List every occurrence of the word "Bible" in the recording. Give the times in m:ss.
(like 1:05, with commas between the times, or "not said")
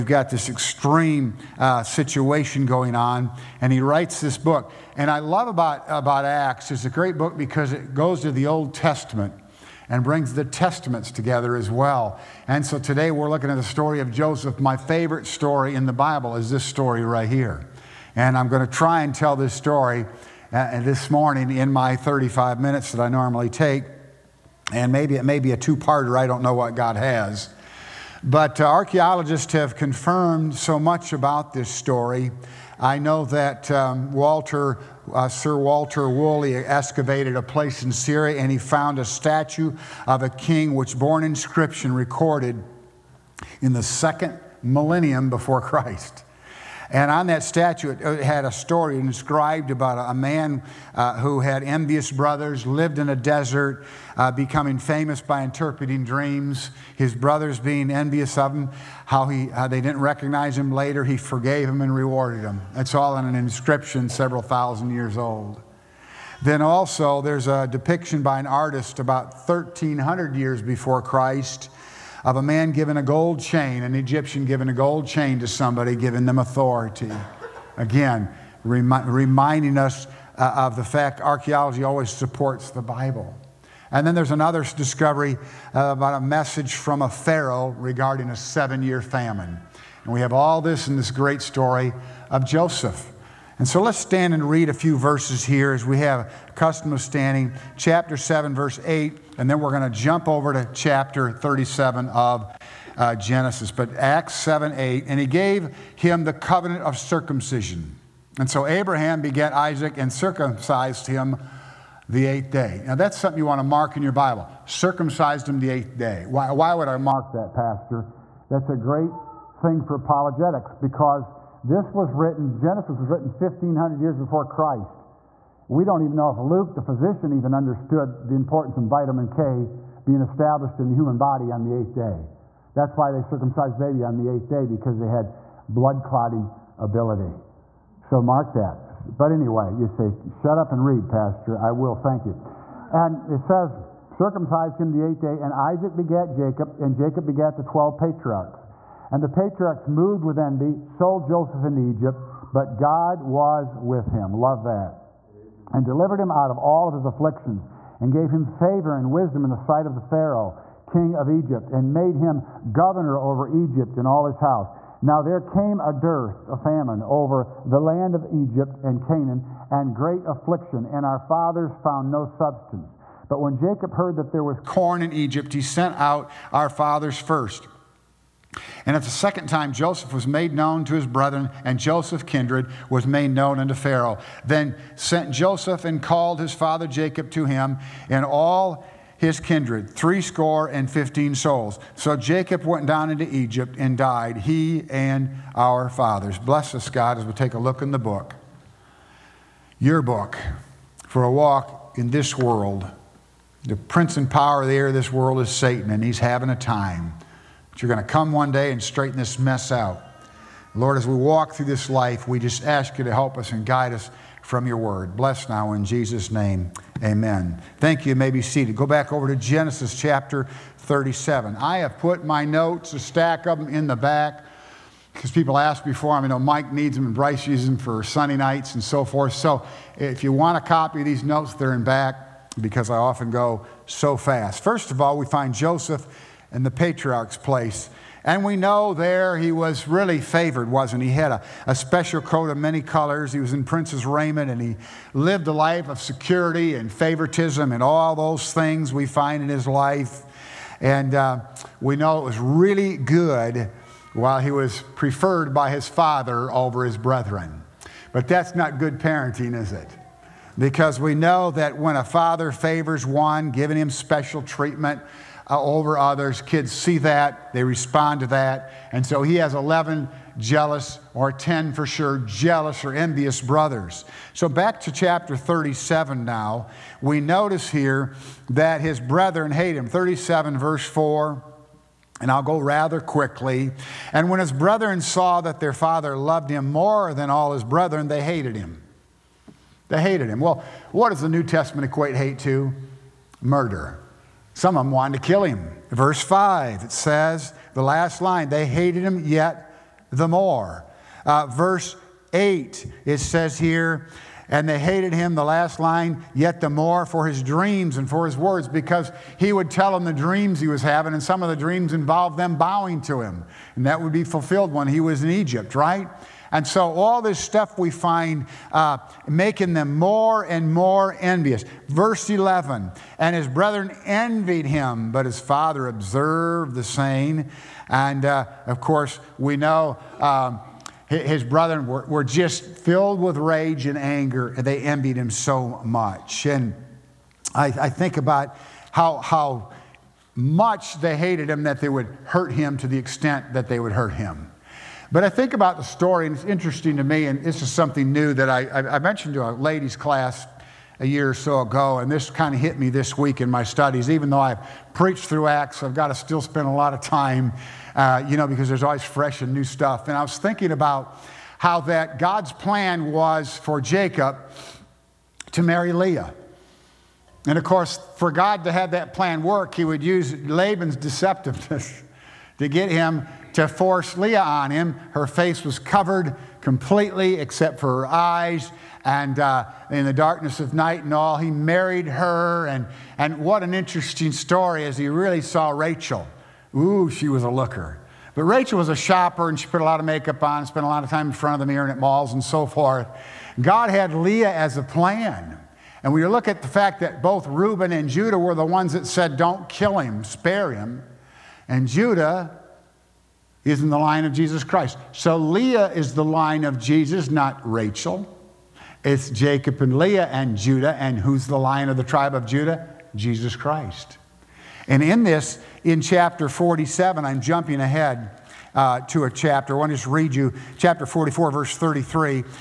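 0:15, 1:22, 1:54.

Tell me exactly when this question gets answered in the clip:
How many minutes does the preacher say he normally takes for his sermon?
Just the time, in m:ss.
0:21.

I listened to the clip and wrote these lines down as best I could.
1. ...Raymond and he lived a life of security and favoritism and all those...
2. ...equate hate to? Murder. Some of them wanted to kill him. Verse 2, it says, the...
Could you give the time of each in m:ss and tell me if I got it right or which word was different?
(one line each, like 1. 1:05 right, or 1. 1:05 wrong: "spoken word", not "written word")
1. 4:04 right
2. 4:51 wrong: "5", not "2".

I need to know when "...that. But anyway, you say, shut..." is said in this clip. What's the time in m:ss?
2:18.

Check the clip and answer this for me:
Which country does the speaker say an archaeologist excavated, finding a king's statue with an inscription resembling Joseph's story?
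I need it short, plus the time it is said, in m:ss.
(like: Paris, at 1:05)
Syria, at 0:37.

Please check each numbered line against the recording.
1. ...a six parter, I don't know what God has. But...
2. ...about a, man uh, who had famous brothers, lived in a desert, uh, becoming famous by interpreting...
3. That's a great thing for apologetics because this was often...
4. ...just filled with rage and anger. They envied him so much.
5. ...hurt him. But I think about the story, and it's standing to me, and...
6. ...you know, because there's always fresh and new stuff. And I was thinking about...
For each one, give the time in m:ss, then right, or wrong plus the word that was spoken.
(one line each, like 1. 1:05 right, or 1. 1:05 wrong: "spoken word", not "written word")
1. 0:25 wrong: "two", not "six"
2. 0:49 wrong: "envious", not "famous"
3. 1:58 wrong: "written", not "often"
4. 5:32 right
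5. 5:43 wrong: "interesting", not "standing"
6. 5:58 right.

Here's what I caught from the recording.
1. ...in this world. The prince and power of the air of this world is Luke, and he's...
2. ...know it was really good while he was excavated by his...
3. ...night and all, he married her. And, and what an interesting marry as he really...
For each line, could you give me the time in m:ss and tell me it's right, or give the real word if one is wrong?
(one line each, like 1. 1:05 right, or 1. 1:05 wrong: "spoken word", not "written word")
1. 3:21 wrong: "Satan", not "Luke"
2. 4:11 wrong: "preferred", not "excavated"
3. 6:20 wrong: "story", not "marry".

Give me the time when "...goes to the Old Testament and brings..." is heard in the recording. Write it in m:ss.
0:07.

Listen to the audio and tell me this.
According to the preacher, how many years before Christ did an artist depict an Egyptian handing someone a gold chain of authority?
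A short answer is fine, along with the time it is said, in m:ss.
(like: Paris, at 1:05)
1,300, at 1:09.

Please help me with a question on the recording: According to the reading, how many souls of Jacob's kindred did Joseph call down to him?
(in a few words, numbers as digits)
Threescore and fifteen.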